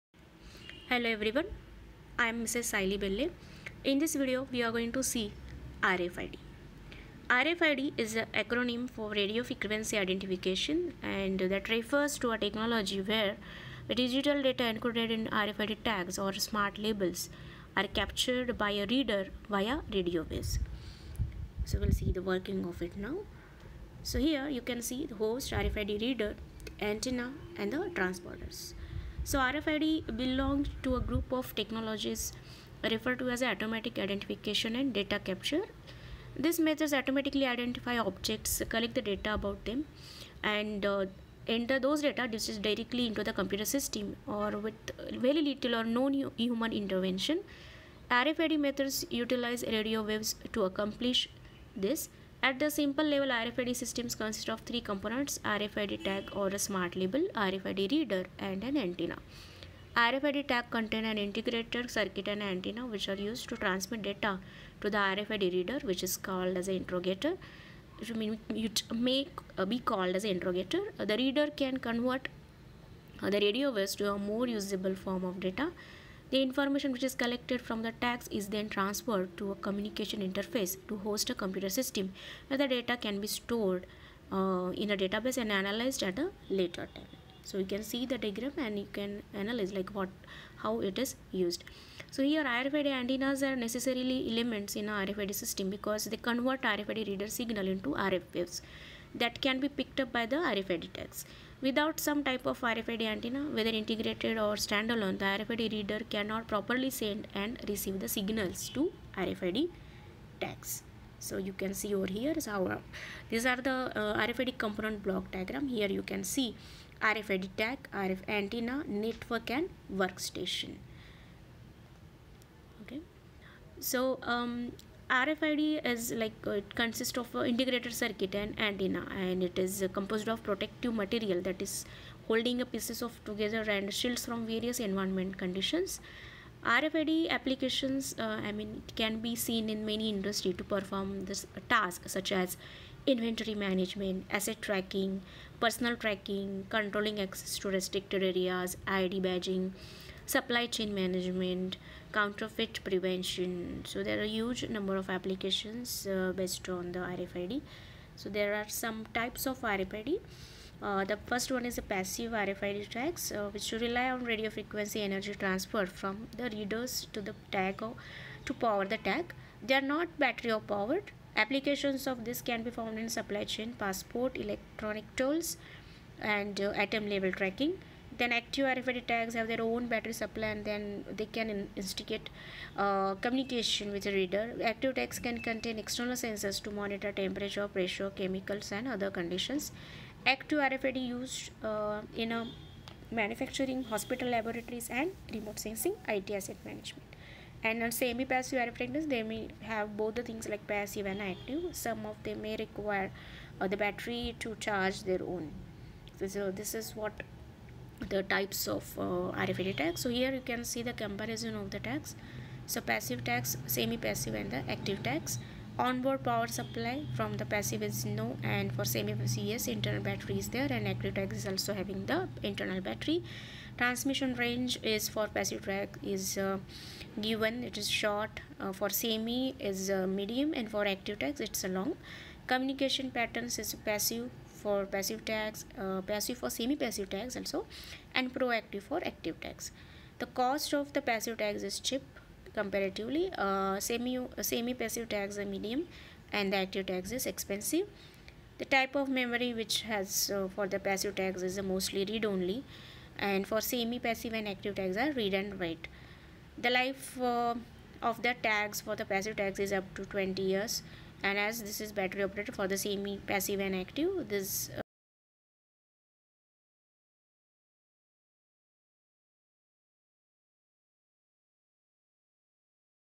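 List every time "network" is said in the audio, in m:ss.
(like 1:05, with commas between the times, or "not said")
1:58.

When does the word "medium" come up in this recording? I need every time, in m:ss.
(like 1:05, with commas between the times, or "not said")
3:50, 4:05.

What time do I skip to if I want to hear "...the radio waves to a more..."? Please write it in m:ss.
1:13.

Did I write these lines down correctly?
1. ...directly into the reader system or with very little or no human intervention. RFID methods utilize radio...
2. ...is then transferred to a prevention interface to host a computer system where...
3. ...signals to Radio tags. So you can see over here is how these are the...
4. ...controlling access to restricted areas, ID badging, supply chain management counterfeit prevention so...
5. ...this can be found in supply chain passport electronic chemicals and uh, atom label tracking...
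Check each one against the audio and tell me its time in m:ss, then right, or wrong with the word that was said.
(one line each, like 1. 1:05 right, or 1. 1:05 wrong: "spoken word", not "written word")
1. 0:42 wrong: "computer", not "reader"
2. 1:18 wrong: "communication", not "prevention"
3. 1:48 wrong: "RFID", not "Radio"
4. 2:26 right
5. 2:52 wrong: "tolls", not "chemicals".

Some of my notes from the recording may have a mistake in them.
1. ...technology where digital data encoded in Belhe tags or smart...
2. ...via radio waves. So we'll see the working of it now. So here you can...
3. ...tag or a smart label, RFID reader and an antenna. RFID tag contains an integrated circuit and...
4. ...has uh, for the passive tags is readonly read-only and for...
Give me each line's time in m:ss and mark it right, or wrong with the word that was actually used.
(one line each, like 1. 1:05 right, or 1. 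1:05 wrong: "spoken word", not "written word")
1. 0:12 wrong: "RFID", not "Belhe"
2. 0:19 right
3. 0:56 right
4. 4:09 wrong: "mostly", not "readonly".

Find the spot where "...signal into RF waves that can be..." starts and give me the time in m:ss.
1:37.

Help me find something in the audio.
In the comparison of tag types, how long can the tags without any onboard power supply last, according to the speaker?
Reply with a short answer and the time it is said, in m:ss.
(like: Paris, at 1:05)
up to 20 years, at 4:19.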